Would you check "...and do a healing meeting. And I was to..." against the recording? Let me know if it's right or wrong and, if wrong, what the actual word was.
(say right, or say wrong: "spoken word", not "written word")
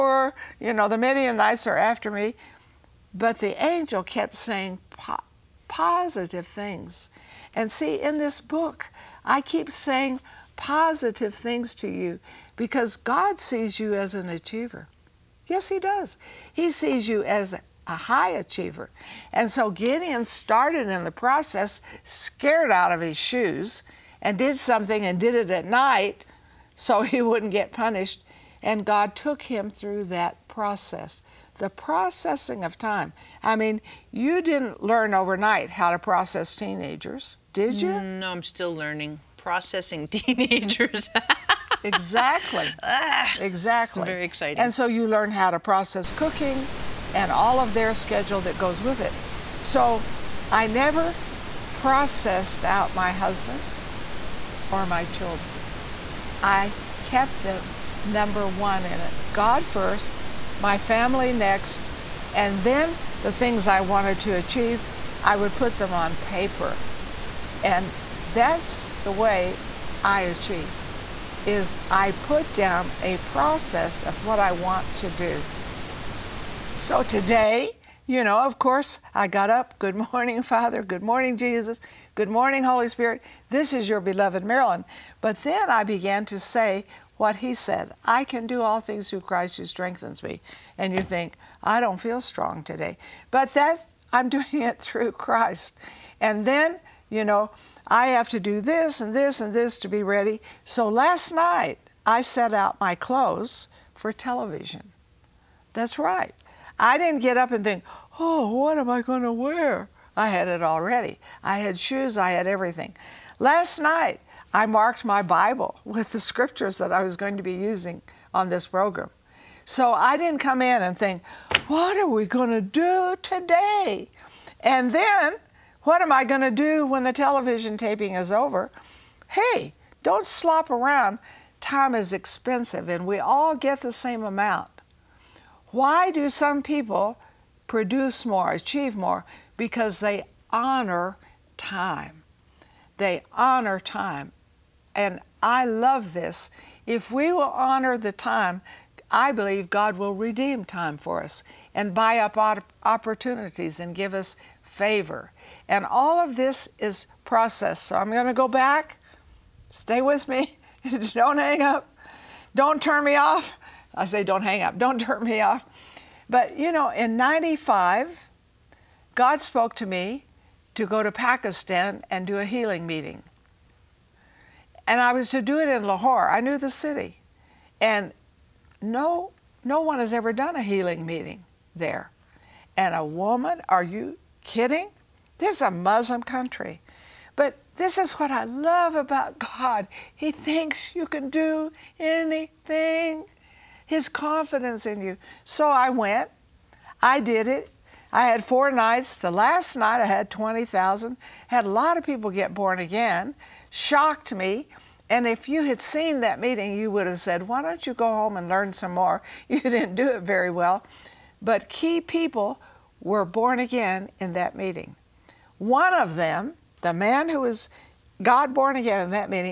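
right.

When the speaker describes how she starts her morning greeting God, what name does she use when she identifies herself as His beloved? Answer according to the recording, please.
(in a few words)
Marilyn.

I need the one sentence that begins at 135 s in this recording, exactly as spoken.
Why do some people produce more, achieve more?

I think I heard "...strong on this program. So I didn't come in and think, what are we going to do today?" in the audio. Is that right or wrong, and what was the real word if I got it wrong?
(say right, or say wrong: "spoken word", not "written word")
wrong: "using", not "strong".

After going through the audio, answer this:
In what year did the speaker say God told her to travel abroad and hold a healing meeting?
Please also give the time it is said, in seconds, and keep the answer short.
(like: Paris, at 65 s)
1995, at 167 s.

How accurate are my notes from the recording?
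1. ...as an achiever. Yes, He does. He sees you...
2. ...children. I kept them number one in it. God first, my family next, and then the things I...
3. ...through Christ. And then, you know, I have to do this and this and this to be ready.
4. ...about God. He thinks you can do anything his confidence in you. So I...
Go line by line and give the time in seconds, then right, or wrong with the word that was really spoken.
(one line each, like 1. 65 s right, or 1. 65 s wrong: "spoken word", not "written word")
1. 13 s right
2. 55 s right
3. 94 s right
4. 188 s right.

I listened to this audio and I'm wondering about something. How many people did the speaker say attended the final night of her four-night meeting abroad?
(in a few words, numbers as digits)
20,000.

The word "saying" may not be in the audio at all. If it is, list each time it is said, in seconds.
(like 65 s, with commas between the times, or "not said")
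4 s, 9 s.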